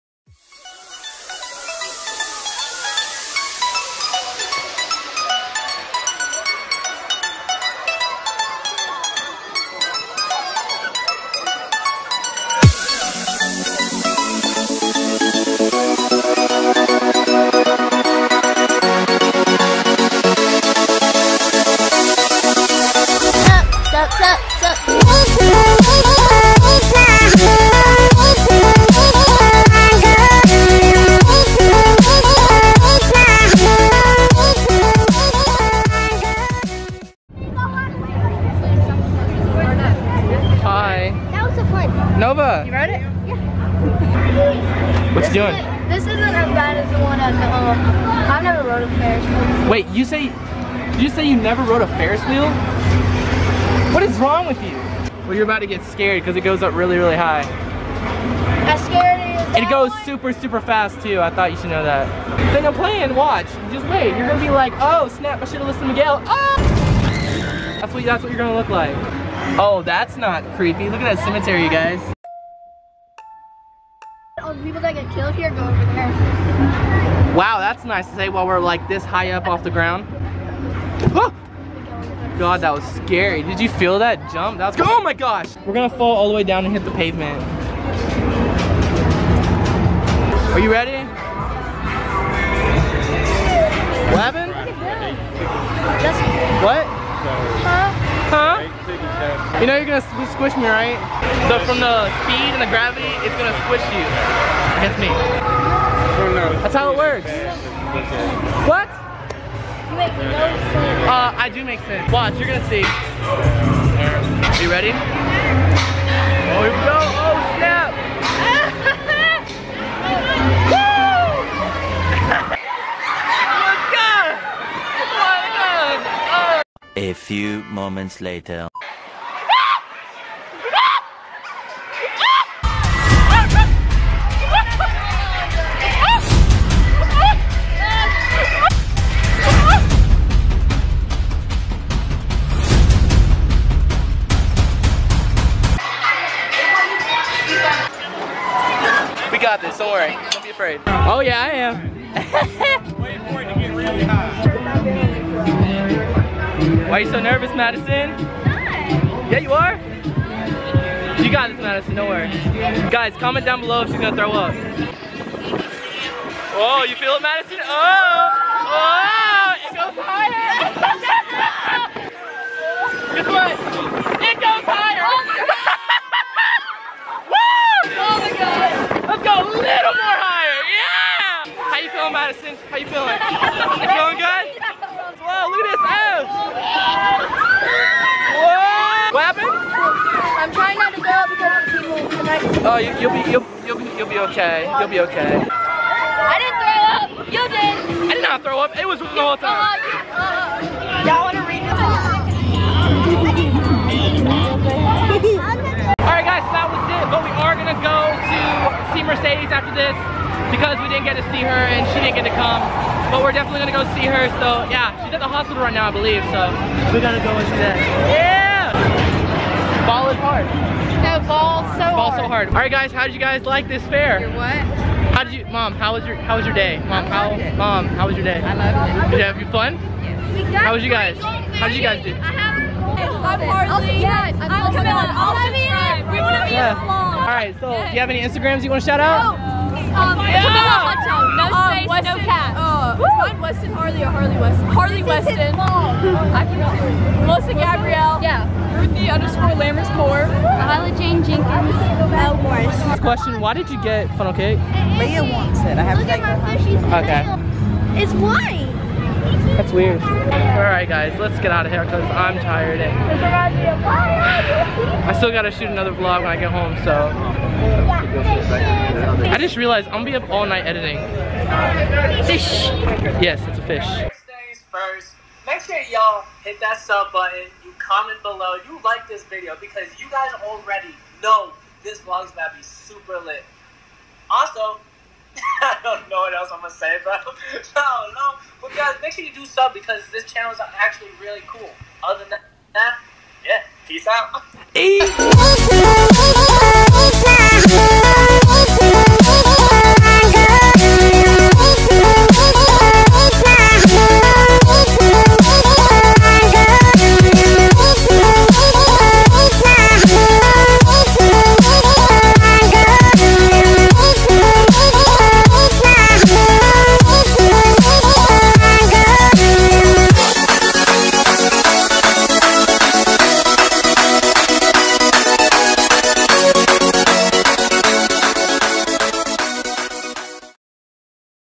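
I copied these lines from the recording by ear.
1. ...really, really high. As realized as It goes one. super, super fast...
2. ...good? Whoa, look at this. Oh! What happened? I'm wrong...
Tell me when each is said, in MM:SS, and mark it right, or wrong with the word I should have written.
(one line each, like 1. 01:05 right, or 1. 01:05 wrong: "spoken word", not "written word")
1. 00:56 wrong: "scared", not "realized"
2. 03:04 wrong: "trying", not "wrong".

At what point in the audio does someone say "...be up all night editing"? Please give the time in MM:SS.
04:30.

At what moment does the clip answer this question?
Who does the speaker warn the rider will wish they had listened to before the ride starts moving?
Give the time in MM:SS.
01:05.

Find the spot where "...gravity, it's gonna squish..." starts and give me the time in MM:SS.
01:42.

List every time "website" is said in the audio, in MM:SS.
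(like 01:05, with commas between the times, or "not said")
not said.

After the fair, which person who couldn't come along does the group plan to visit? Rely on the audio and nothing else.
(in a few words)
Mercedes.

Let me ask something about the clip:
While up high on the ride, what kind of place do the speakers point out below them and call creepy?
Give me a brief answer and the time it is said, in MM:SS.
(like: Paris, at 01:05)
Cemetery, at 01:11.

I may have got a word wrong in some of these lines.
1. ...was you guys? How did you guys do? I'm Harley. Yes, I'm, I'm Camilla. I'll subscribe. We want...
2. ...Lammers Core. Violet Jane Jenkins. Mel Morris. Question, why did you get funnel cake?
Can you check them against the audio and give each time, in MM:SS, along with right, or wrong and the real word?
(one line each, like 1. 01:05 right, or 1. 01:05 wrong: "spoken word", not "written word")
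1. 03:50 right
2. 04:09 right.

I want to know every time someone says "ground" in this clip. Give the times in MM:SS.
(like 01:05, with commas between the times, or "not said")
01:19.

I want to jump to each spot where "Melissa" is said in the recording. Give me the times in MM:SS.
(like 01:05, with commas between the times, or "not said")
04:07.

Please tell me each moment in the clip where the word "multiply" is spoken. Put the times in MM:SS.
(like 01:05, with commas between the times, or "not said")
not said.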